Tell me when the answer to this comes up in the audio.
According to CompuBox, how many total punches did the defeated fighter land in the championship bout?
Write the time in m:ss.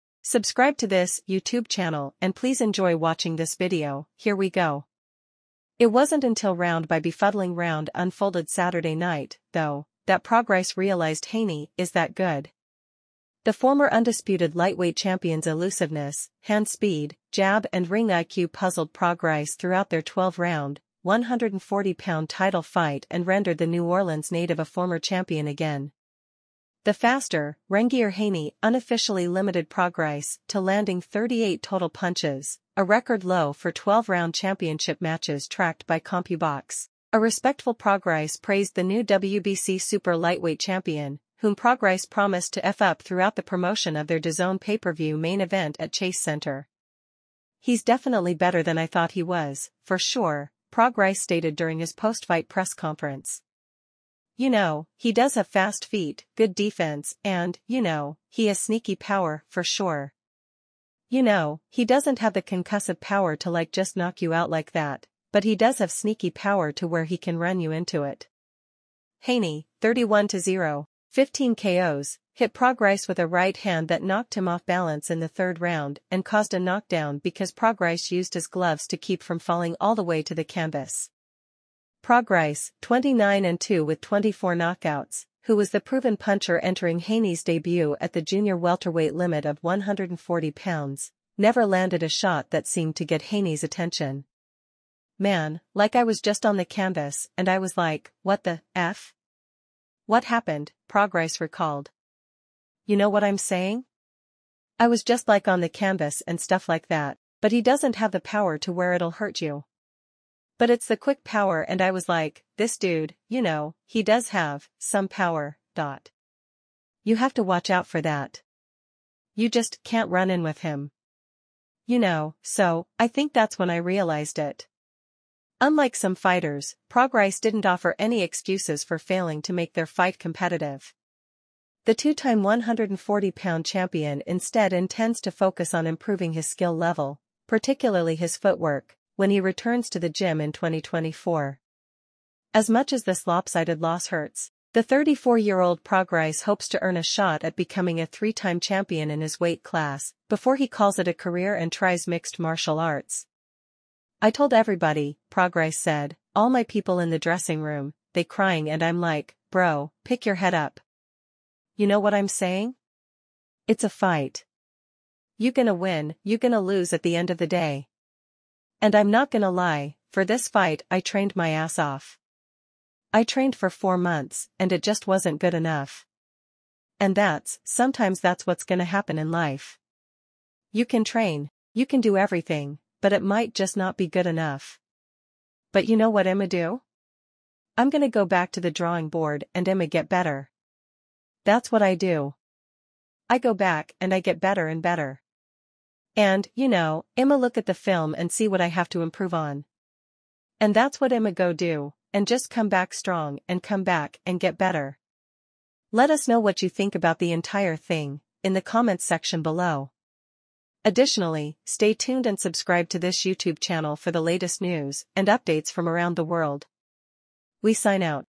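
0:30.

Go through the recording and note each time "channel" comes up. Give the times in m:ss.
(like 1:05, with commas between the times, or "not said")
0:01, 3:33.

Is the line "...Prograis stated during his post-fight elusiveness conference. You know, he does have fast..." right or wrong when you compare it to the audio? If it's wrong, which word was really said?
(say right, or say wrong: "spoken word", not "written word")
wrong: "press", not "elusiveness".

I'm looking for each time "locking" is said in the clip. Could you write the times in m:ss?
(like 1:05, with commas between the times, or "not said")
not said.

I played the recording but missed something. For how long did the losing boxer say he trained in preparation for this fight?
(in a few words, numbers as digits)
four months.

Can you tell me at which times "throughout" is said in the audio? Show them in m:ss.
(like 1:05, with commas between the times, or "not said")
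0:19, 0:43.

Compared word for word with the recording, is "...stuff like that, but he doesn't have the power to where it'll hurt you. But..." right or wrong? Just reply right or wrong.
right.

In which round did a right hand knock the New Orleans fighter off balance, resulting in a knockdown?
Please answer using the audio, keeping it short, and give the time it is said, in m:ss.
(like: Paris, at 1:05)
third, at 1:15.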